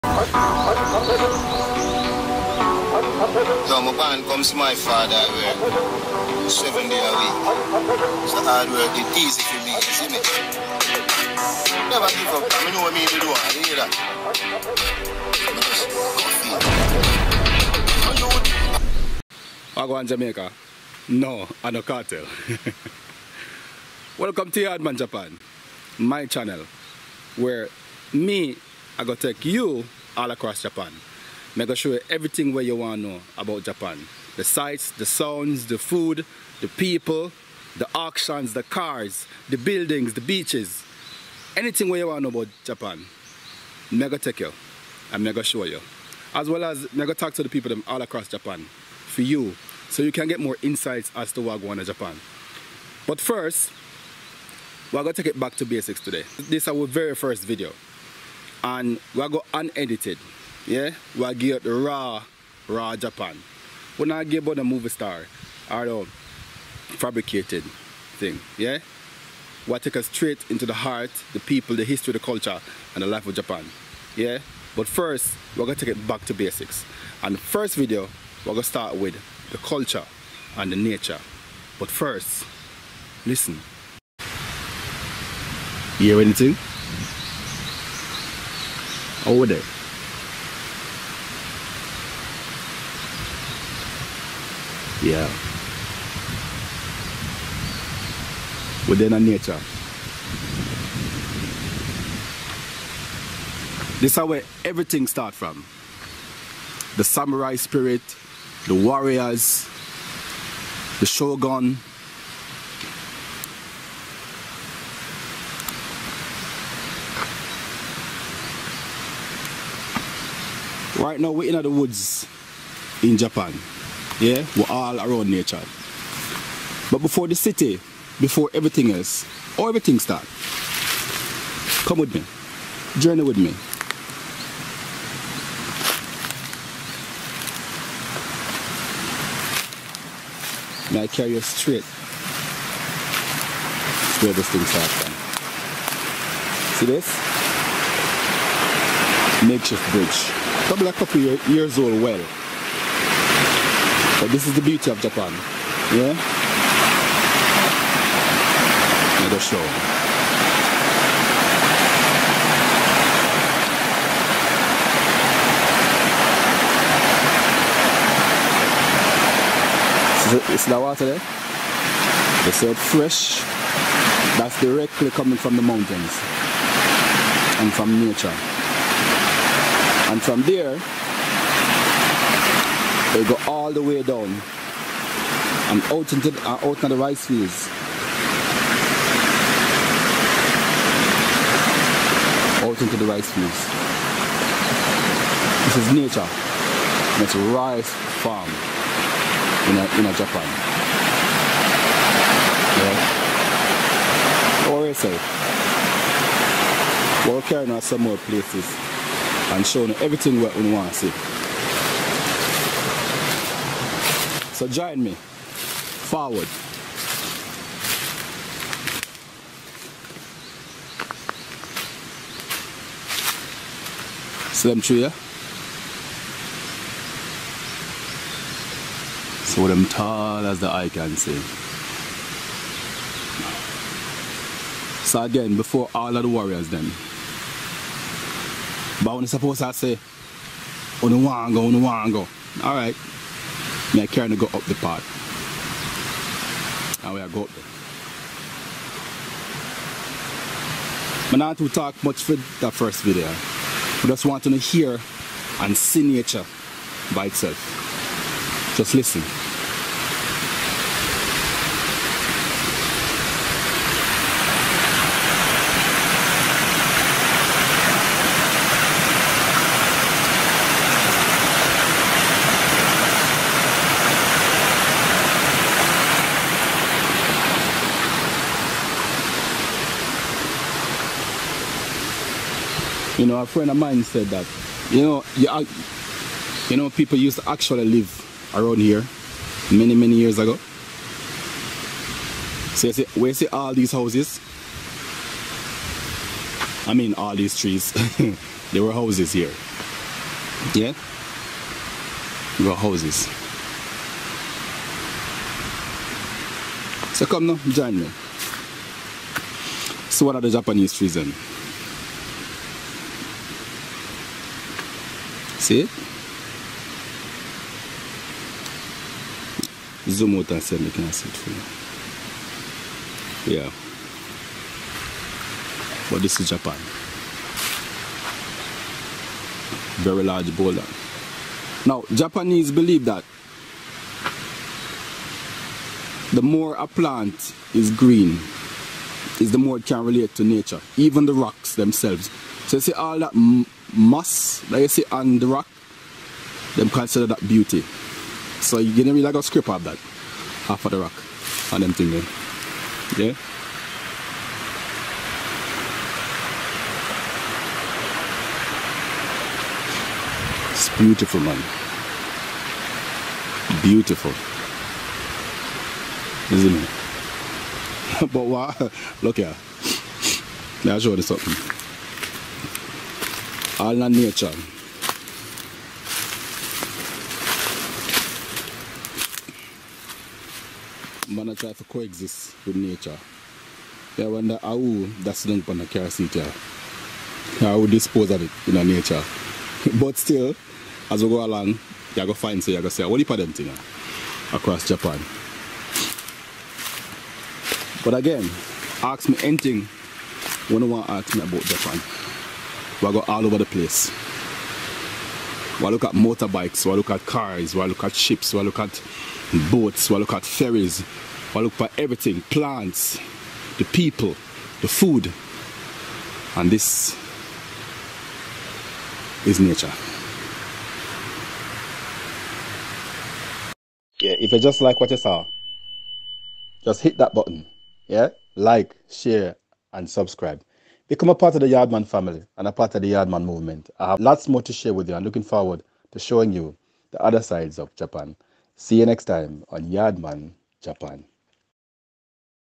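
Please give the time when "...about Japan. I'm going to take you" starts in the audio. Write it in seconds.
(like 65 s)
42 s.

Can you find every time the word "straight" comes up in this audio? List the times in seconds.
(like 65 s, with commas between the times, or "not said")
70 s, 141 s.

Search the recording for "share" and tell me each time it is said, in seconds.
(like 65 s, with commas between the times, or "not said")
429 s, 434 s.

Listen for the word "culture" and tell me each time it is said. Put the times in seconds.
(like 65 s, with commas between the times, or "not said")
72 s, 79 s.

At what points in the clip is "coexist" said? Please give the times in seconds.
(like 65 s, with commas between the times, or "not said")
381 s.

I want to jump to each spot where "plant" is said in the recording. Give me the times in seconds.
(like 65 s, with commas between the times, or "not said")
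336 s, 412 s.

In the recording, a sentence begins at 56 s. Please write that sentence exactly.
This is our very first video and we go unedited.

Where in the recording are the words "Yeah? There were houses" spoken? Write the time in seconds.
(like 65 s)
300 s.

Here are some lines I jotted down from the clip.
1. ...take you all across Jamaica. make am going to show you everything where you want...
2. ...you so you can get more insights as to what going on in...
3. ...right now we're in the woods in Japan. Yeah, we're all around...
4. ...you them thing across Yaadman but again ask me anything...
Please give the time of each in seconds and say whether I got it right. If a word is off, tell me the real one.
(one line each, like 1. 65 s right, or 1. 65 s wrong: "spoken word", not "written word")
1. 29 s wrong: "Japan", not "Jamaica"
2. 49 s right
3. 121 s right
4. 393 s wrong: "Japan", not "Yaadman".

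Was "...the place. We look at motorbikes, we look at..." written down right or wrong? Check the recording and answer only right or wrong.
right.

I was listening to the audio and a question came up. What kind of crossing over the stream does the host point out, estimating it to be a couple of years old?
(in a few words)
Makeshift bridge.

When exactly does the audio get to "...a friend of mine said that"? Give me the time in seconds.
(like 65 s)
283 s.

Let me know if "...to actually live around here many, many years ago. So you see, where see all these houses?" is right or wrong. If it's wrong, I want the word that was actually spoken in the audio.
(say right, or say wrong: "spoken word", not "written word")
right.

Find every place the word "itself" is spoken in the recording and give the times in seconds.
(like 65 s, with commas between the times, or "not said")
257 s.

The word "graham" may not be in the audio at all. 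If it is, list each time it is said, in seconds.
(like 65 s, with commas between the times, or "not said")
not said.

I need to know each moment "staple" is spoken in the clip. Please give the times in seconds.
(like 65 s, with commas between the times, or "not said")
not said.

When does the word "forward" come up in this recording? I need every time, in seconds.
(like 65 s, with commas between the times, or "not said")
215 s, 435 s.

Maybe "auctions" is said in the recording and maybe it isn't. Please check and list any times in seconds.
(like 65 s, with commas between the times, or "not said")
37 s.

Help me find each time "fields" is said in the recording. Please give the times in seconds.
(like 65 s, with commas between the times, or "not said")
187 s, 193 s.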